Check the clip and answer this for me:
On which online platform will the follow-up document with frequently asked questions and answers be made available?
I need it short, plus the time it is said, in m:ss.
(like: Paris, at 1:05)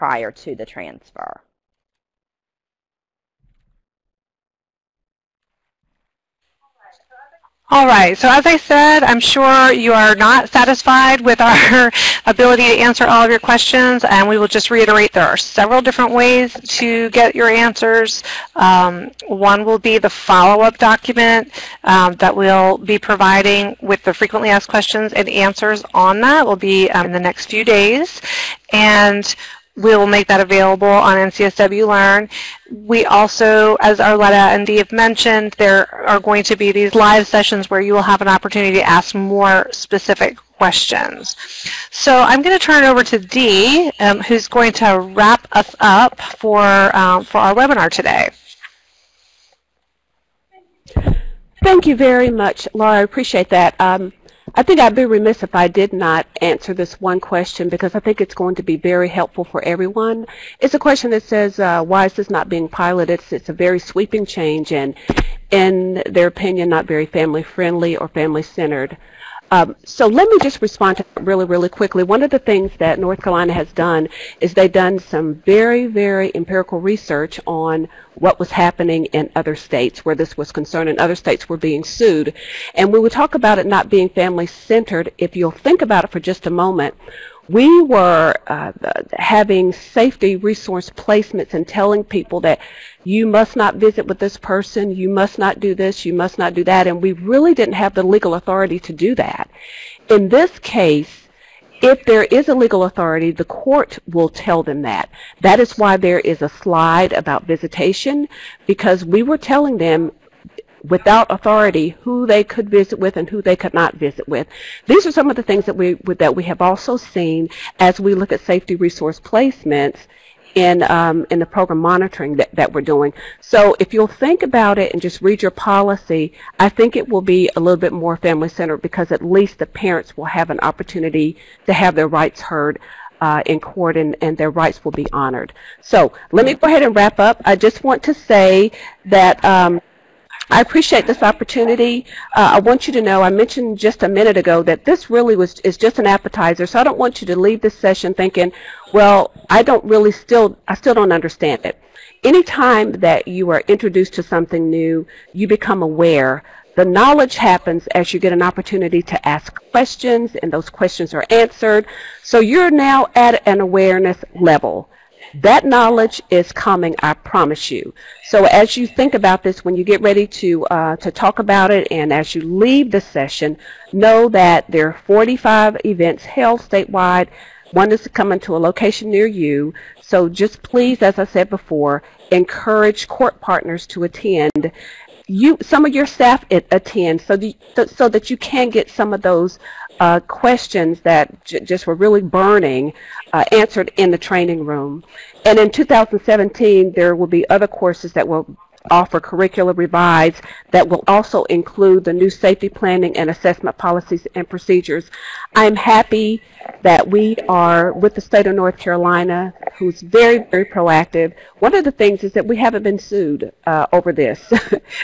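NCSW Learn, at 0:31.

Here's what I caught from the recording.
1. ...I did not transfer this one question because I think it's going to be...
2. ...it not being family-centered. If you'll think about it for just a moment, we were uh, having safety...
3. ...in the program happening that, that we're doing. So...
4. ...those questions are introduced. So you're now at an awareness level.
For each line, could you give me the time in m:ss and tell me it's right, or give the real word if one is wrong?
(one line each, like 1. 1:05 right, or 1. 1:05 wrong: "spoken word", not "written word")
1. 0:55 wrong: "answer", not "transfer"
2. 1:23 right
3. 2:01 wrong: "monitoring", not "happening"
4. 2:40 wrong: "answered", not "introduced".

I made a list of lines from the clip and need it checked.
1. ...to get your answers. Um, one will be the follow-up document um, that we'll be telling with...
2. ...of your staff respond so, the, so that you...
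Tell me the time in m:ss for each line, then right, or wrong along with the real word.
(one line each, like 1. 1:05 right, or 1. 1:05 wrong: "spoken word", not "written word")
1. 0:16 wrong: "providing", not "telling"
2. 3:05 wrong: "attend", not "respond".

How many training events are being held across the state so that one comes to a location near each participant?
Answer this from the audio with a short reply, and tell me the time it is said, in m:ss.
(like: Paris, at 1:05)
45, at 2:55.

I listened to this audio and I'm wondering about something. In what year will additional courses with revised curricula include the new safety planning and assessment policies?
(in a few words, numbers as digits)
2017.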